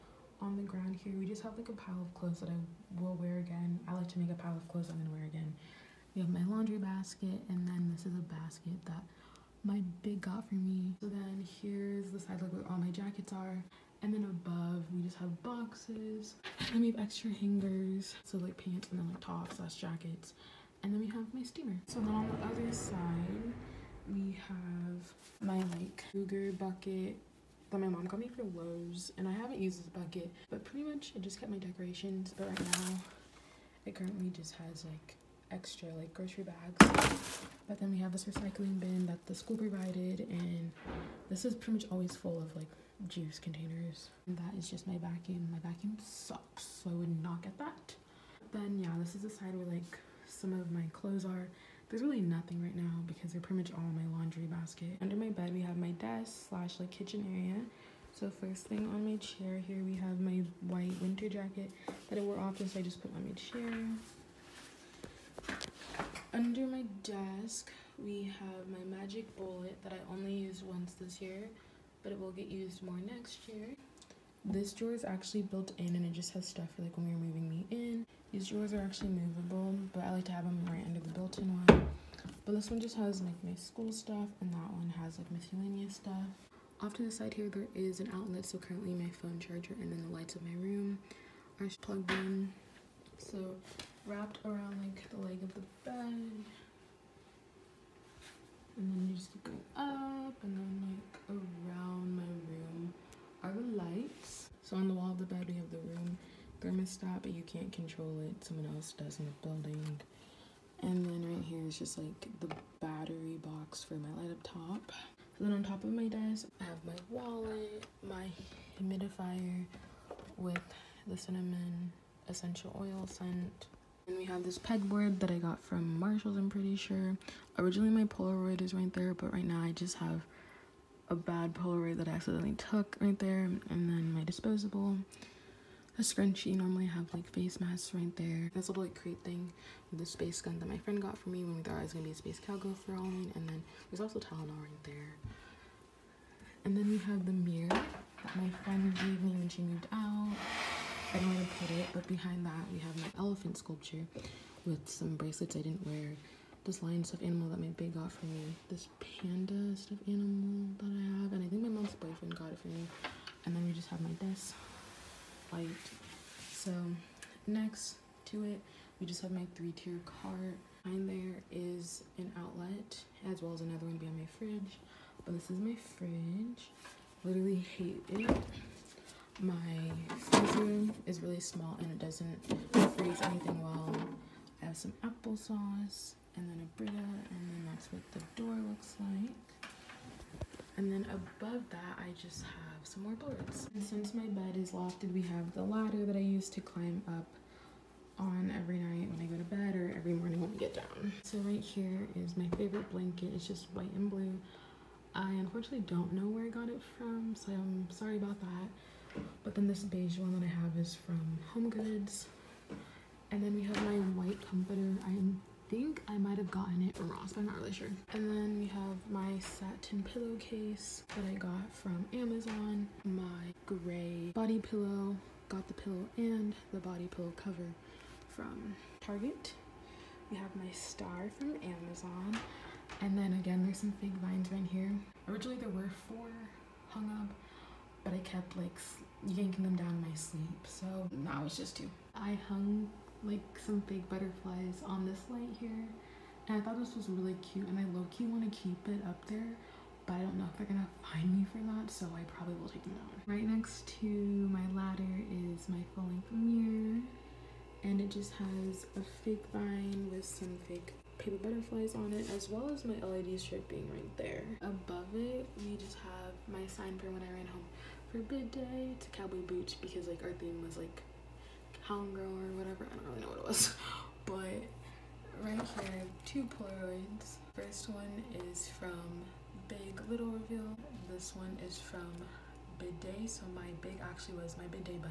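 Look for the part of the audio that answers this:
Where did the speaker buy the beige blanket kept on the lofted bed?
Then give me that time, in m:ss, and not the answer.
3:31.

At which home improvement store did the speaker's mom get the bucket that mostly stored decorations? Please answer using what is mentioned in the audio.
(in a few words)
Lowe's.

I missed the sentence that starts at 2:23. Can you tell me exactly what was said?
And then there's also Tylenol right there.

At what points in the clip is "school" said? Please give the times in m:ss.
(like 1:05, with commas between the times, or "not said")
0:39, 1:23.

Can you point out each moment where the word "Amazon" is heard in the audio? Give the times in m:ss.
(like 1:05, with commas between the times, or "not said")
3:42, 3:51.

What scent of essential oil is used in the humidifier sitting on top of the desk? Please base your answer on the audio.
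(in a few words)
Cinnamon.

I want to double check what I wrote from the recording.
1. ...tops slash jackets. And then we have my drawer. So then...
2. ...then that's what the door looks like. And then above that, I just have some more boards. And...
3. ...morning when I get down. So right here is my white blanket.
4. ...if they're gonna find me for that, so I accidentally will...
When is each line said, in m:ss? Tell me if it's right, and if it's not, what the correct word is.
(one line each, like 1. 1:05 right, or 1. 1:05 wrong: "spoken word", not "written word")
1. 0:19 wrong: "steamer", not "drawer"
2. 3:07 right
3. 3:20 wrong: "favorite", not "white"
4. 4:10 wrong: "probably", not "accidentally".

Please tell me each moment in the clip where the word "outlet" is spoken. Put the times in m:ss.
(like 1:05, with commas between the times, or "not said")
1:28, 2:52.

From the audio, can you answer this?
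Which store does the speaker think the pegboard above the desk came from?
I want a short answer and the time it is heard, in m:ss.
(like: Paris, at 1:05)
Marshalls, at 2:05.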